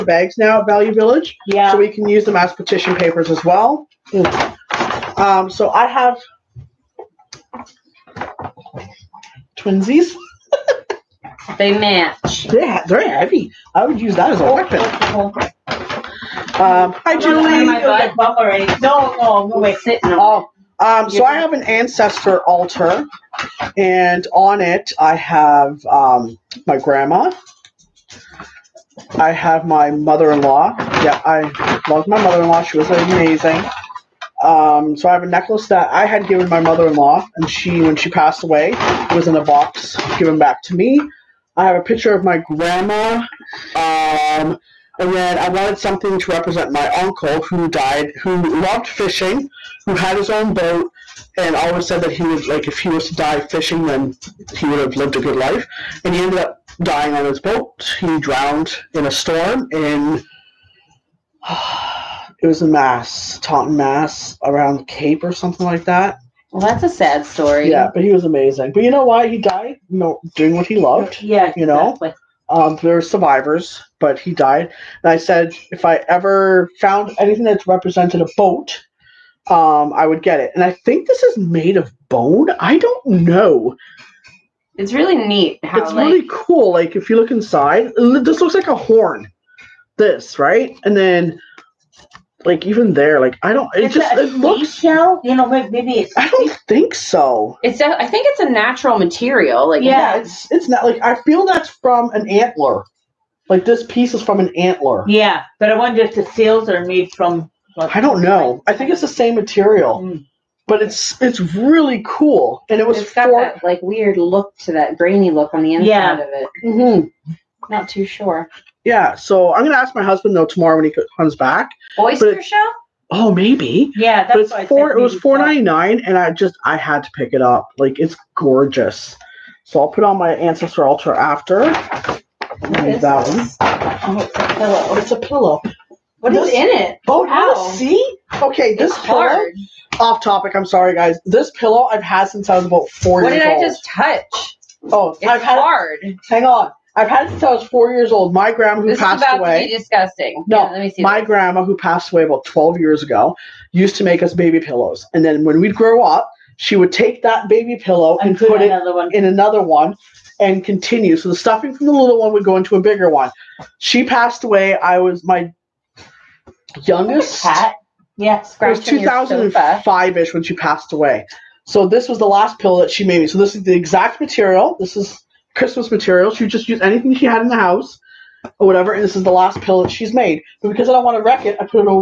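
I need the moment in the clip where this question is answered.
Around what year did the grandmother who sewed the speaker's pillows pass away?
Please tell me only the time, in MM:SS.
02:48.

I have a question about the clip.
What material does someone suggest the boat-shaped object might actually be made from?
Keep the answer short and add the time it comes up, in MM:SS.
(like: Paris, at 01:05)
Oyster shell, at 02:01.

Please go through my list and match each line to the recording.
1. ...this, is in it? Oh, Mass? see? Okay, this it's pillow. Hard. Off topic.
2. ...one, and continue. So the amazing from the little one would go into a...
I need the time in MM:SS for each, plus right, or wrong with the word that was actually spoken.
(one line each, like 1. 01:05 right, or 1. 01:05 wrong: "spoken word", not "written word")
1. 02:16 wrong: "How", not "Mass"
2. 02:39 wrong: "stuffing", not "amazing".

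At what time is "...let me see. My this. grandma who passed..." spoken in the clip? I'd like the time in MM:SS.
02:30.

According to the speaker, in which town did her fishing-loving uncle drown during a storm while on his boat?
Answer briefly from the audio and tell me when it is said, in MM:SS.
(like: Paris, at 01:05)
Taunton, Mass, at 01:03.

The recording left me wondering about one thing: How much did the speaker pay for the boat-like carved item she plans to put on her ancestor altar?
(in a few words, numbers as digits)
$4.99.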